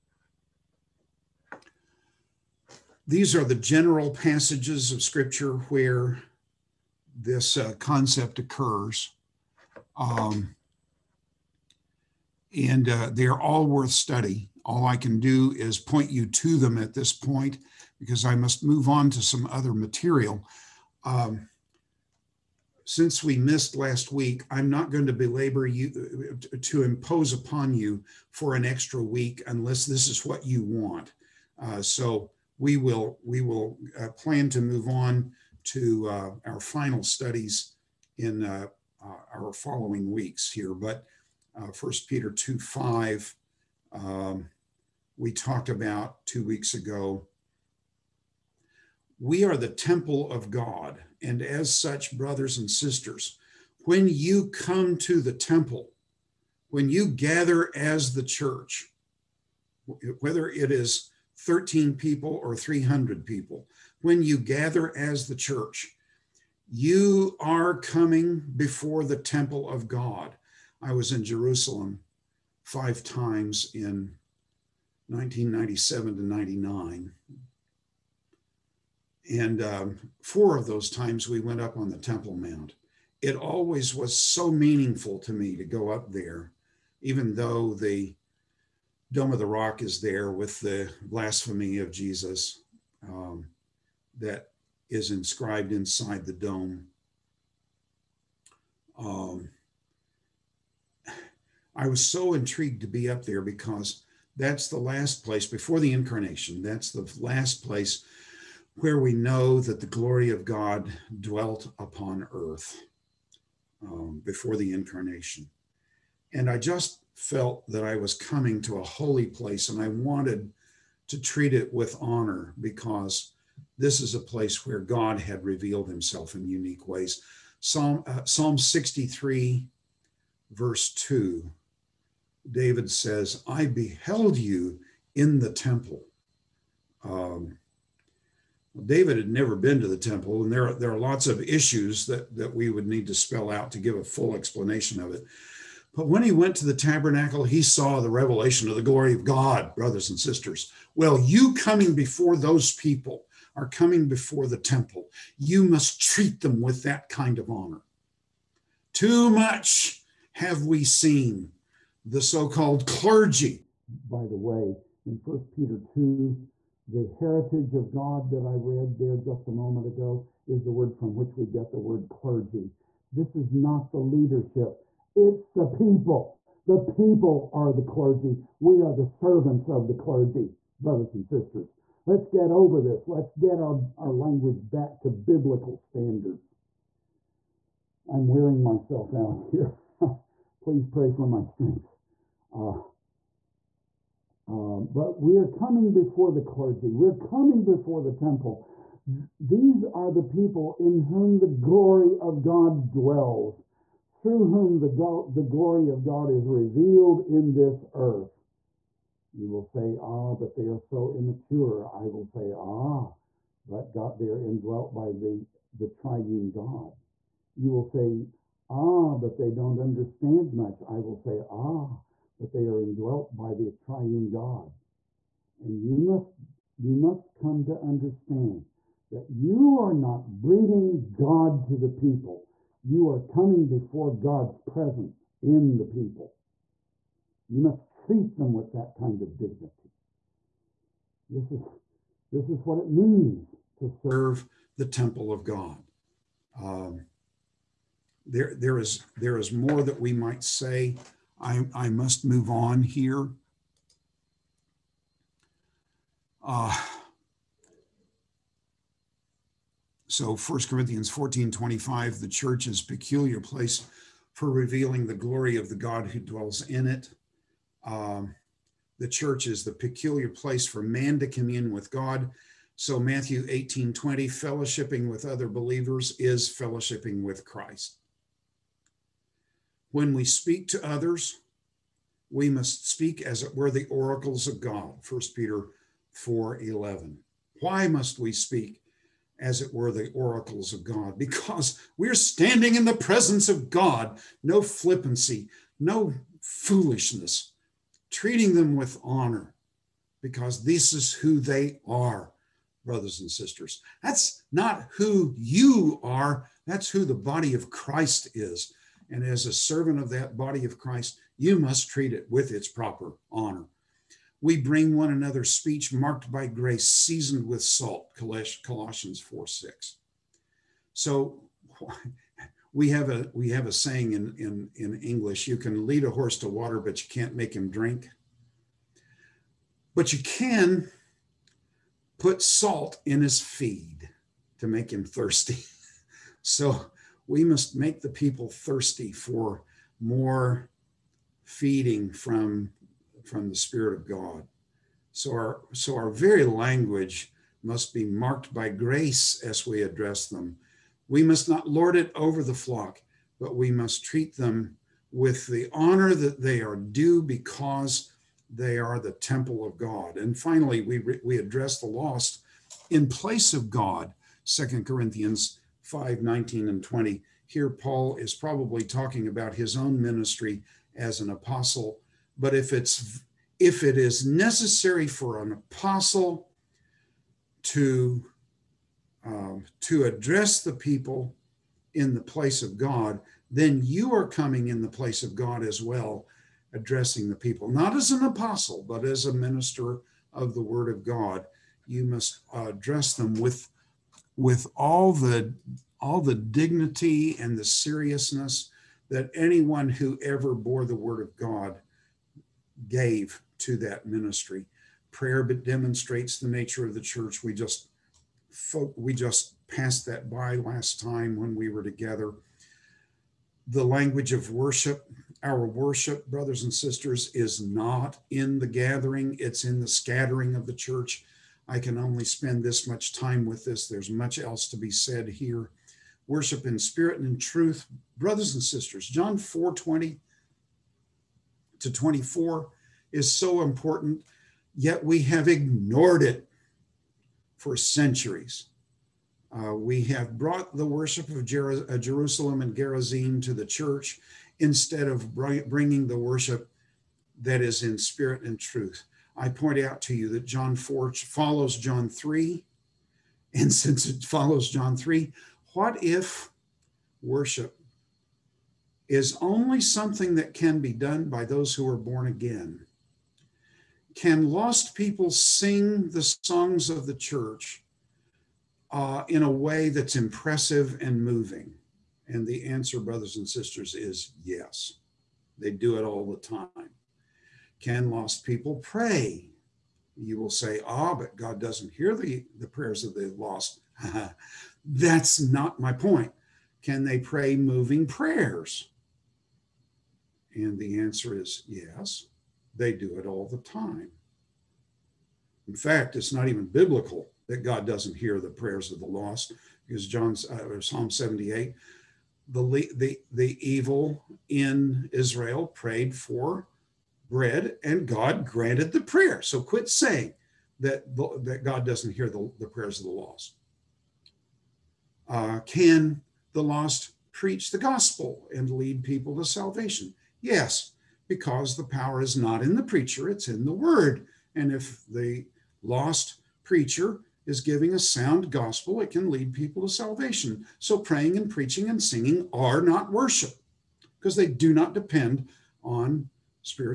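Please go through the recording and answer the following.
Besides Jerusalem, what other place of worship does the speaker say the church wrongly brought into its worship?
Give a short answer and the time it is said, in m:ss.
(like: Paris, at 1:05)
Gerizim, at 7:22.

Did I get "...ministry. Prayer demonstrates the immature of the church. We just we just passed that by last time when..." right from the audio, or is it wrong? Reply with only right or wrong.
wrong.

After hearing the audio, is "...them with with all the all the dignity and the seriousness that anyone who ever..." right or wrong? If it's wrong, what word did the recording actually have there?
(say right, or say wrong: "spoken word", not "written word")
right.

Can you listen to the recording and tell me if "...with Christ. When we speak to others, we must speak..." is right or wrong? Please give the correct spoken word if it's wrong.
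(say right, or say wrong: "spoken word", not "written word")
right.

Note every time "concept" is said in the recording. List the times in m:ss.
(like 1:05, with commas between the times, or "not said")
0:07.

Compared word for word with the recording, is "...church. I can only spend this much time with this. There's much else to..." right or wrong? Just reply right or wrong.
right.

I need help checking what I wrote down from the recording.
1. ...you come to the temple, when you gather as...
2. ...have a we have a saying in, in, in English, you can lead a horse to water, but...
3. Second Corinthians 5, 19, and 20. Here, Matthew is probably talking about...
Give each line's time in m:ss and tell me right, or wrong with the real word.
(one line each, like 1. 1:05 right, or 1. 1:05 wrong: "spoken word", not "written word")
1. 0:54 right
2. 5:22 right
3. 6:04 wrong: "Paul", not "Matthew".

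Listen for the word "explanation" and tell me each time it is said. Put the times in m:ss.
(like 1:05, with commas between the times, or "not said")
2:24.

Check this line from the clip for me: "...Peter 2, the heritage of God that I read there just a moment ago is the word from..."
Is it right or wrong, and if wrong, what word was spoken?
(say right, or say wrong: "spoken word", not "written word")
right.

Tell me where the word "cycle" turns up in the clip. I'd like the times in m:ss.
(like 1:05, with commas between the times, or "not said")
not said.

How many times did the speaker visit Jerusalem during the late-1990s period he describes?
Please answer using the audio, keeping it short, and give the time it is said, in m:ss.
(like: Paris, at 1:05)
5, at 1:12.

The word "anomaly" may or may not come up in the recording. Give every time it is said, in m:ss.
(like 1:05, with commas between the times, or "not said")
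not said.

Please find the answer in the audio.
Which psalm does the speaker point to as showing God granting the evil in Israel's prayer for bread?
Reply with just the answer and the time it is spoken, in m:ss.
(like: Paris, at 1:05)
Psalm 78, at 8:20.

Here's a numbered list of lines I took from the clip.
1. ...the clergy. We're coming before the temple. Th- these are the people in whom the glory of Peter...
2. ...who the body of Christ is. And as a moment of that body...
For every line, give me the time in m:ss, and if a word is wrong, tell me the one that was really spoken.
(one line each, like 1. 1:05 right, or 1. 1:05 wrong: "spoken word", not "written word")
1. 3:16 wrong: "God", not "Peter"
2. 5:06 wrong: "servant", not "moment".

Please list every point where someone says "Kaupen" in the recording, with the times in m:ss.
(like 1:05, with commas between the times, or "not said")
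not said.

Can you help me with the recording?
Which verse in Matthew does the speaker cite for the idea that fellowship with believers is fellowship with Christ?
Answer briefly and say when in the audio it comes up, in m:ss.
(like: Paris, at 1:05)
Matthew 18:20, at 4:32.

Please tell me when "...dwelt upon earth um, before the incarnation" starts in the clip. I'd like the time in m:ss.
1:51.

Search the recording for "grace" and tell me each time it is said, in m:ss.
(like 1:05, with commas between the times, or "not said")
5:16, 5:48.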